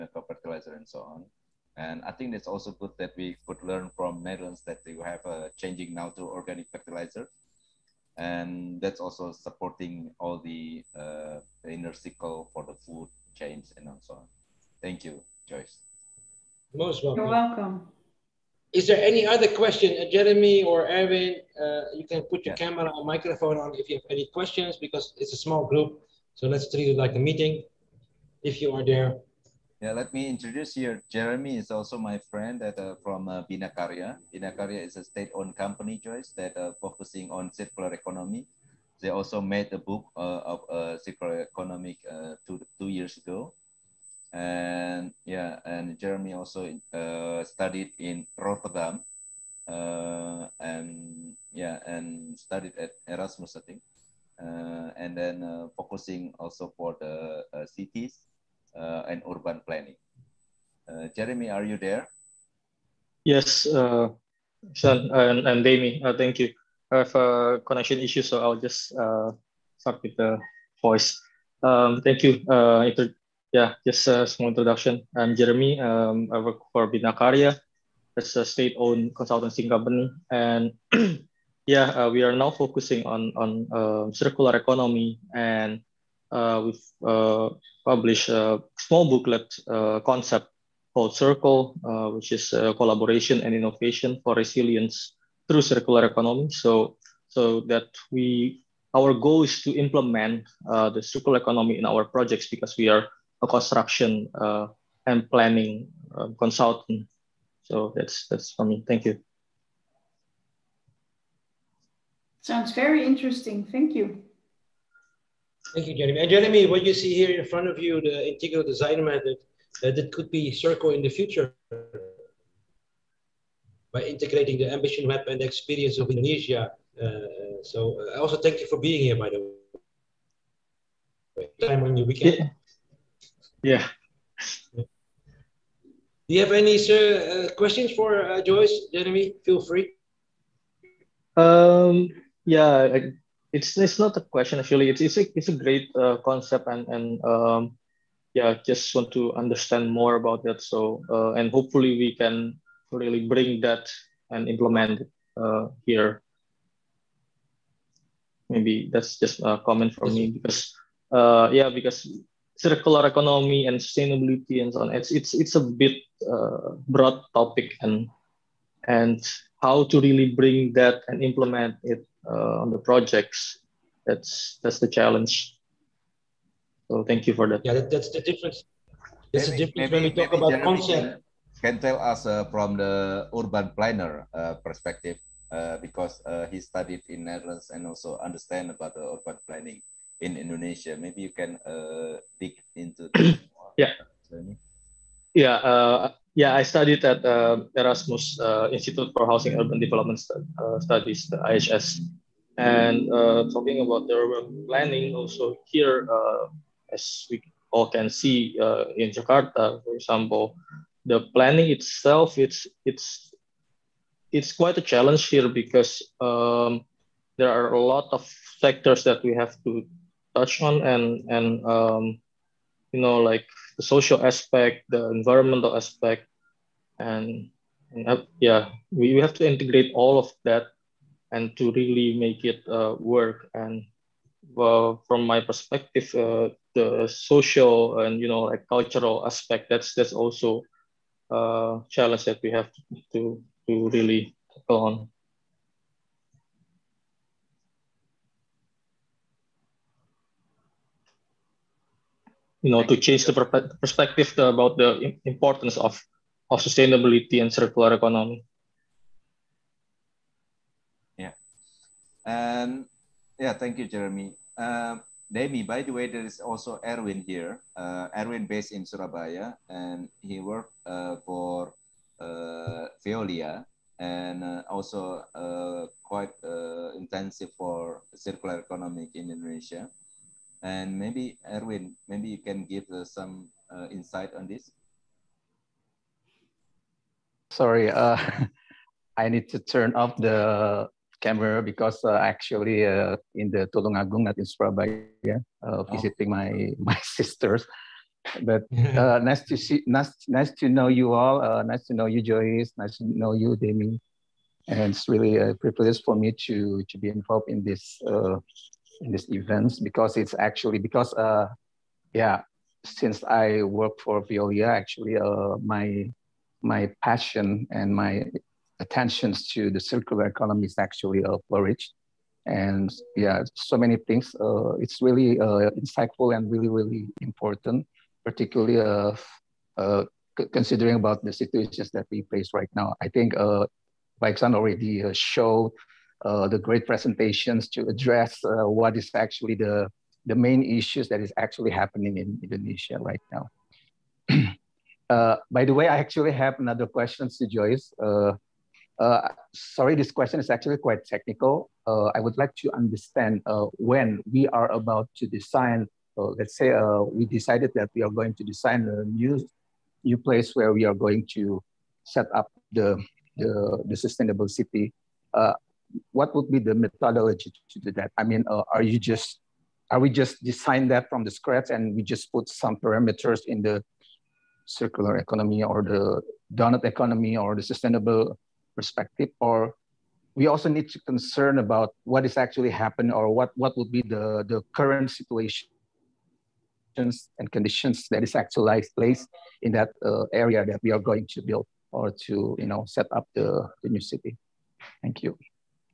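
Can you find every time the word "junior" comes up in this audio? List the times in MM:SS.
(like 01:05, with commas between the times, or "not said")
not said.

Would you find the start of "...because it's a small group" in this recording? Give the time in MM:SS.
00:24.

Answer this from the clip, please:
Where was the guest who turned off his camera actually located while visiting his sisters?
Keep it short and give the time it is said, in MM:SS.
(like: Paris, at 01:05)
Tulungagung, at 04:53.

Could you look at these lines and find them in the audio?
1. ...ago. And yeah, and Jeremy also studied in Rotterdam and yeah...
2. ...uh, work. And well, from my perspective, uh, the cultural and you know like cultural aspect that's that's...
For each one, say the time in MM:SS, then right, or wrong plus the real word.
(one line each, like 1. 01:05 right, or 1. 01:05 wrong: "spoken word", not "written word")
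1. 00:43 right
2. 03:52 wrong: "social", not "cultural".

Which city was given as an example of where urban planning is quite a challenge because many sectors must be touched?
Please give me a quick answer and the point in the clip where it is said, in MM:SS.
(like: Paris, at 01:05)
Jakarta, at 03:29.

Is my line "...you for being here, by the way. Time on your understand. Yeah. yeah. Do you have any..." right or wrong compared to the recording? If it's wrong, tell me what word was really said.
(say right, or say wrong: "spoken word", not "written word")
wrong: "weekend", not "understand".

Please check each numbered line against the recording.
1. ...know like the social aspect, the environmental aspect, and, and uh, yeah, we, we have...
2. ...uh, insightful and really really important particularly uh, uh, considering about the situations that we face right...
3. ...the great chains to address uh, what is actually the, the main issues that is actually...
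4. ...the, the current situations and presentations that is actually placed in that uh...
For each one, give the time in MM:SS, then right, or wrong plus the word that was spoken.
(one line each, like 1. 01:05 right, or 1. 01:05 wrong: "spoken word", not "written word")
1. 03:42 right
2. 05:25 right
3. 05:36 wrong: "presentations", not "chains"
4. 06:24 wrong: "conditions", not "presentations".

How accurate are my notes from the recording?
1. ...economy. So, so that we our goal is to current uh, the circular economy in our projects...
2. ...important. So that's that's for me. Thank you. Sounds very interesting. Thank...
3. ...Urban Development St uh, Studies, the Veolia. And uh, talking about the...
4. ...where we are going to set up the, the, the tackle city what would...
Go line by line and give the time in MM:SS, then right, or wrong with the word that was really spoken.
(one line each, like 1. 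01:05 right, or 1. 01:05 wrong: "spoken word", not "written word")
1. 01:36 wrong: "implement", not "current"
2. 01:46 wrong: "consultant", not "important"
3. 03:19 wrong: "IHS", not "Veolia"
4. 06:00 wrong: "sustainable", not "tackle".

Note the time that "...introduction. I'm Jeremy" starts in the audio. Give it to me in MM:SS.
01:14.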